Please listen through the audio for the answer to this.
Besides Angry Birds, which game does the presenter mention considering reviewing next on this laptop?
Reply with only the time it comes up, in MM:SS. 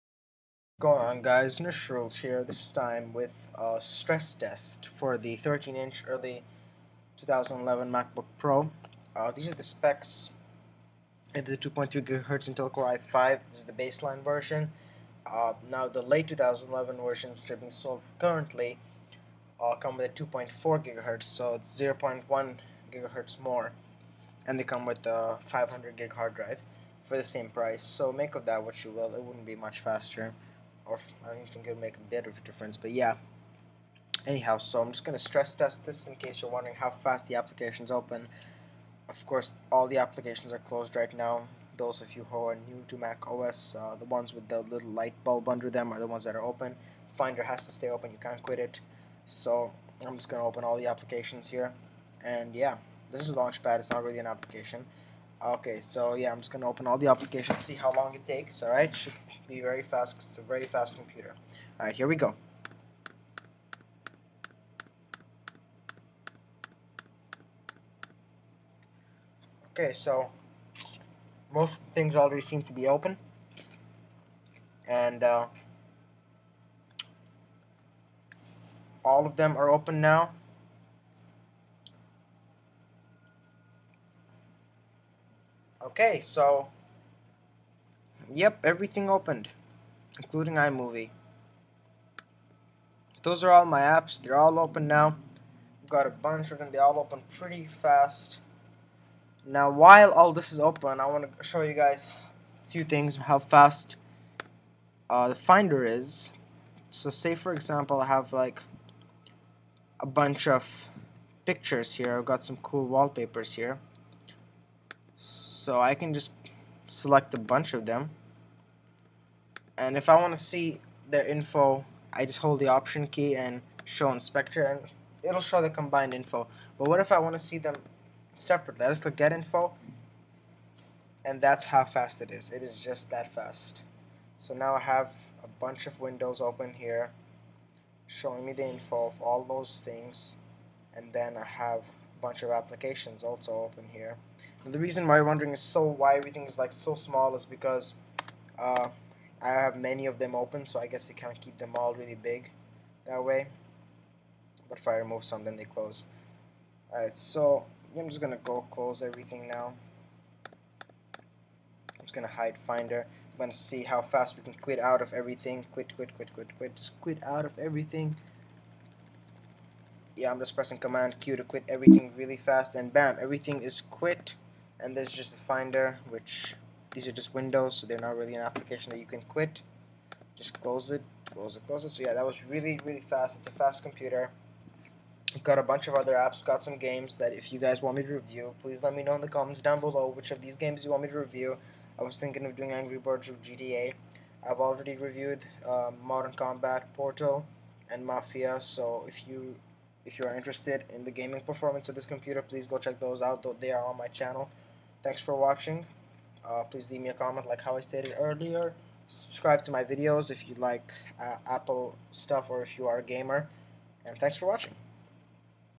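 03:13.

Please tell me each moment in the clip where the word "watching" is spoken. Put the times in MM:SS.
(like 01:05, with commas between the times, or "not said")
03:25, 03:34.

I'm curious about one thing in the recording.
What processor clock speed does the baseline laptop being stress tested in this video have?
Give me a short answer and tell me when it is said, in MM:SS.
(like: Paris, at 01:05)
2.3 GHz, at 00:11.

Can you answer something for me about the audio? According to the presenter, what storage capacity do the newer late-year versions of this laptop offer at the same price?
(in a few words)
500 gig.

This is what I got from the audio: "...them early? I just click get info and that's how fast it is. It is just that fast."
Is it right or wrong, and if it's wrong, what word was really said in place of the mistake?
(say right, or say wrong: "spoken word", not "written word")
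wrong: "separately", not "early".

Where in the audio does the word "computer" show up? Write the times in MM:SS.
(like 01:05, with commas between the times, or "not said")
01:00, 03:03, 03:22.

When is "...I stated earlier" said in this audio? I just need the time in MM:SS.
03:27.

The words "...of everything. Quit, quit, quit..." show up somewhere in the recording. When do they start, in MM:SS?
02:45.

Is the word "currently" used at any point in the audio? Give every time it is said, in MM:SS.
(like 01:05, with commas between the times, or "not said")
00:18.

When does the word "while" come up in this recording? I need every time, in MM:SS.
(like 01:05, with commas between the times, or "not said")
01:39.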